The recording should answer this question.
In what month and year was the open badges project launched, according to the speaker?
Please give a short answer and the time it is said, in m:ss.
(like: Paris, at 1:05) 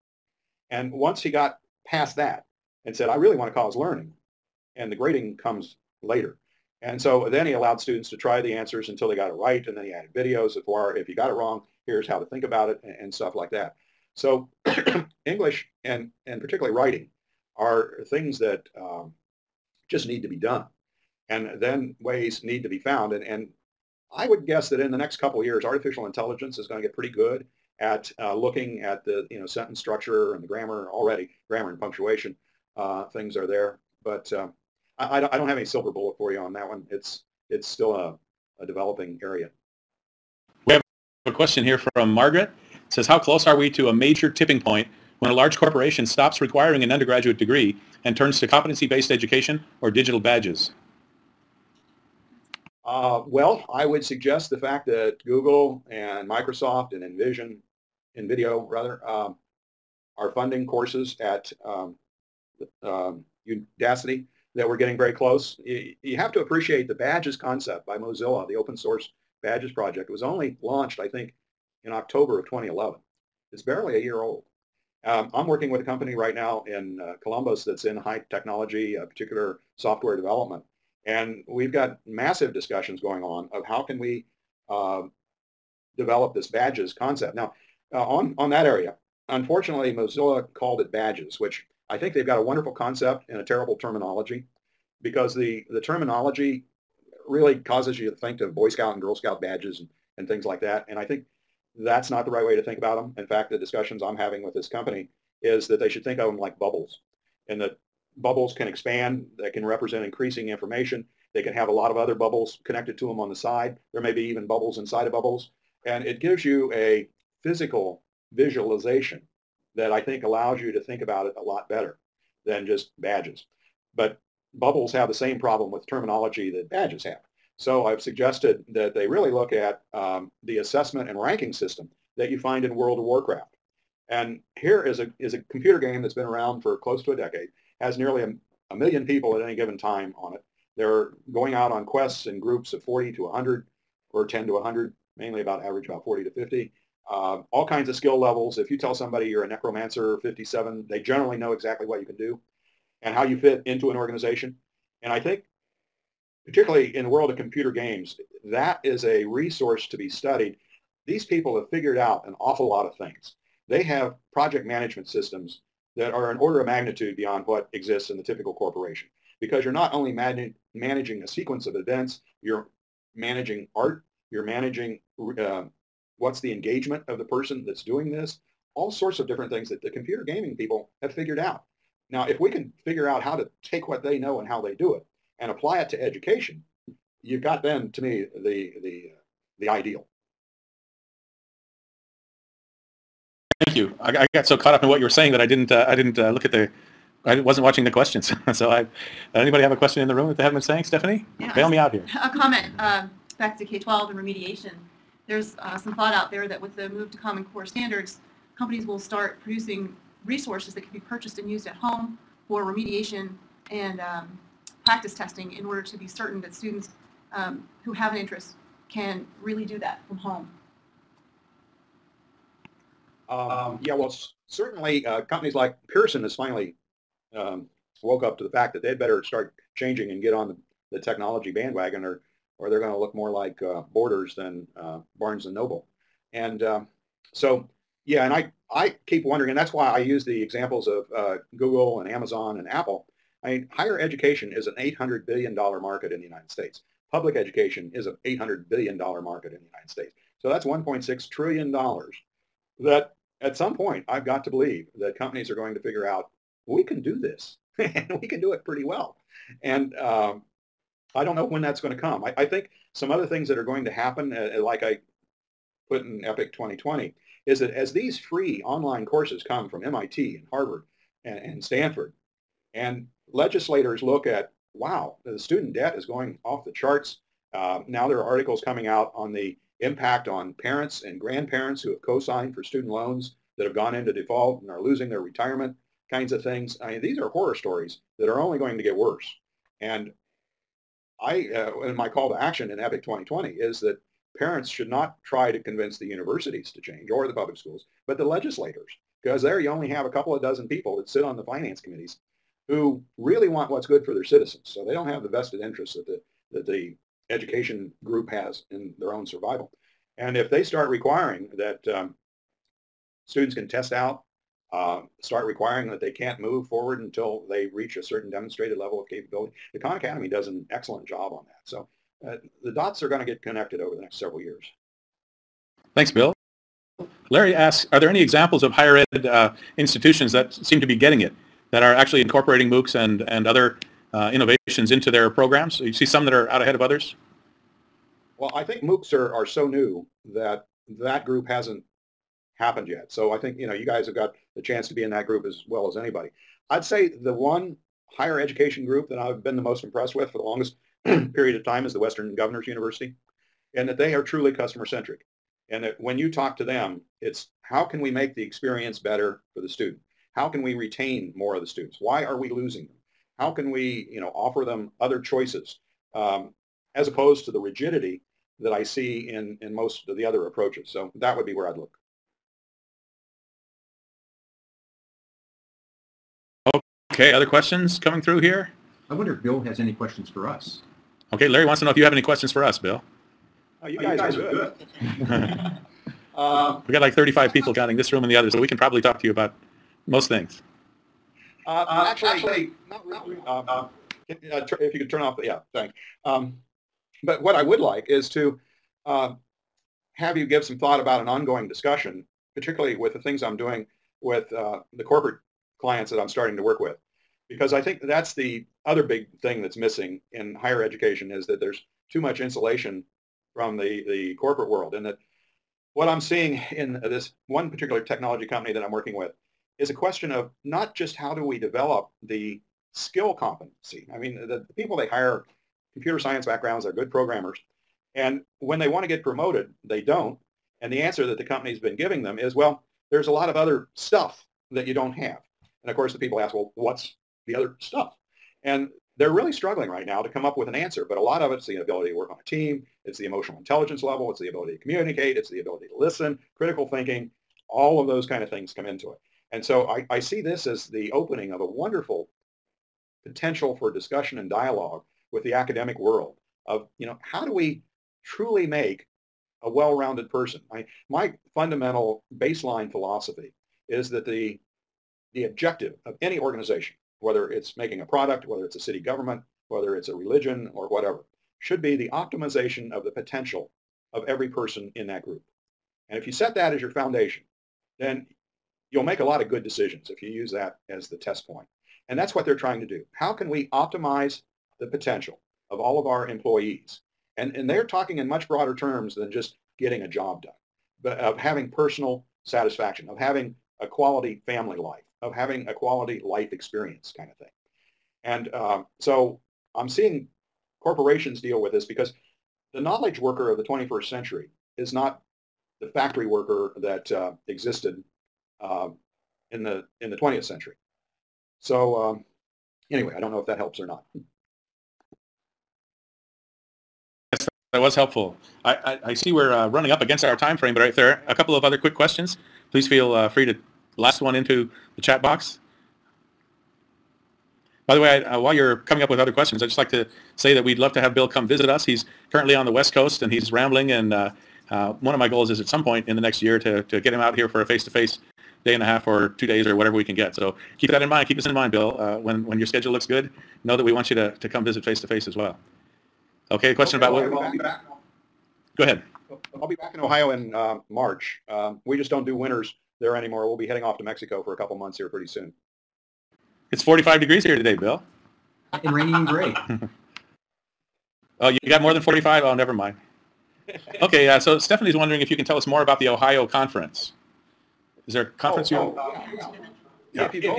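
October 2011, at 1:11.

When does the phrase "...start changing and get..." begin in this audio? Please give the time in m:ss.
3:49.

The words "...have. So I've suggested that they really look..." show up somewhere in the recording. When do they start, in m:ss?
2:07.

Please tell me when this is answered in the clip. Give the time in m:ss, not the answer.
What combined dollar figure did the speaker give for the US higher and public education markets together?
4:10.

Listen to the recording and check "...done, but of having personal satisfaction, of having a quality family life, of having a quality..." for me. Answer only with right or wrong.
right.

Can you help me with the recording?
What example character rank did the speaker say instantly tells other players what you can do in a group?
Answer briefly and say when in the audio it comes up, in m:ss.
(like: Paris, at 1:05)
Necromancer 57, at 2:29.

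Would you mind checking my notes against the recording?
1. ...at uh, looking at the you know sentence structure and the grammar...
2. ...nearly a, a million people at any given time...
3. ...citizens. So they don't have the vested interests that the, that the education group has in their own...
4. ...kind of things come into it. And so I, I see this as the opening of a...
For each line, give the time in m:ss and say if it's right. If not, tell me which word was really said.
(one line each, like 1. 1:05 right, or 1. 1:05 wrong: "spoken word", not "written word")
1. 0:27 right
2. 2:17 right
3. 5:04 right
4. 7:28 right.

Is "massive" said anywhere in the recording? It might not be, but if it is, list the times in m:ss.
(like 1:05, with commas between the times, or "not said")
1:22.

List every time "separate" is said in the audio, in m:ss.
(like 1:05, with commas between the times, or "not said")
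not said.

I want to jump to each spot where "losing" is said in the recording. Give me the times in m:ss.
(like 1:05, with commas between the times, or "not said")
4:44, 6:02.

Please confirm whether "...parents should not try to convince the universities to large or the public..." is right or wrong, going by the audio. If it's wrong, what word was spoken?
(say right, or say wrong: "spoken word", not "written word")
wrong: "change", not "large".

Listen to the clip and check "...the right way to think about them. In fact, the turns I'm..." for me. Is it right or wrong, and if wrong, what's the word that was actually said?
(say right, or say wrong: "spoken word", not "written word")
wrong: "discussions", not "turns".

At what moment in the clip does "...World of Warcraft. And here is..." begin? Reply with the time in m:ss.
2:12.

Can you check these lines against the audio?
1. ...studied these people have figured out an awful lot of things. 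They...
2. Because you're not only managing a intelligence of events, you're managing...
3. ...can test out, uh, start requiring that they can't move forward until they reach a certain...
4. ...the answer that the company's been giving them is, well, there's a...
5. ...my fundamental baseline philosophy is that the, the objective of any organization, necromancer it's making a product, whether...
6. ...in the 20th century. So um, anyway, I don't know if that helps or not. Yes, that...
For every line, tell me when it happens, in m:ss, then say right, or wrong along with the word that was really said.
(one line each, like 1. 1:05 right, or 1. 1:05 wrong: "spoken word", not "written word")
1. 2:40 right
2. 2:49 wrong: "sequence", not "intelligence"
3. 5:13 right
4. 7:10 right
5. 7:41 wrong: "whether", not "necromancer"
6. 8:30 right.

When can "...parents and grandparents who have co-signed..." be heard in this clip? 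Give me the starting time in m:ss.
4:40.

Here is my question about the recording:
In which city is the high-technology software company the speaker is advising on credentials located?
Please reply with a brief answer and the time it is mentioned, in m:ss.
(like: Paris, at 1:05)
Columbus, at 1:17.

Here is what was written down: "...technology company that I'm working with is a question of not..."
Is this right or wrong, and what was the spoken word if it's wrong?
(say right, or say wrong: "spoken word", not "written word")
right.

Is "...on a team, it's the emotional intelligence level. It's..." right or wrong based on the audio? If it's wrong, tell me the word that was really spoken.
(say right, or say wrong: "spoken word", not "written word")
right.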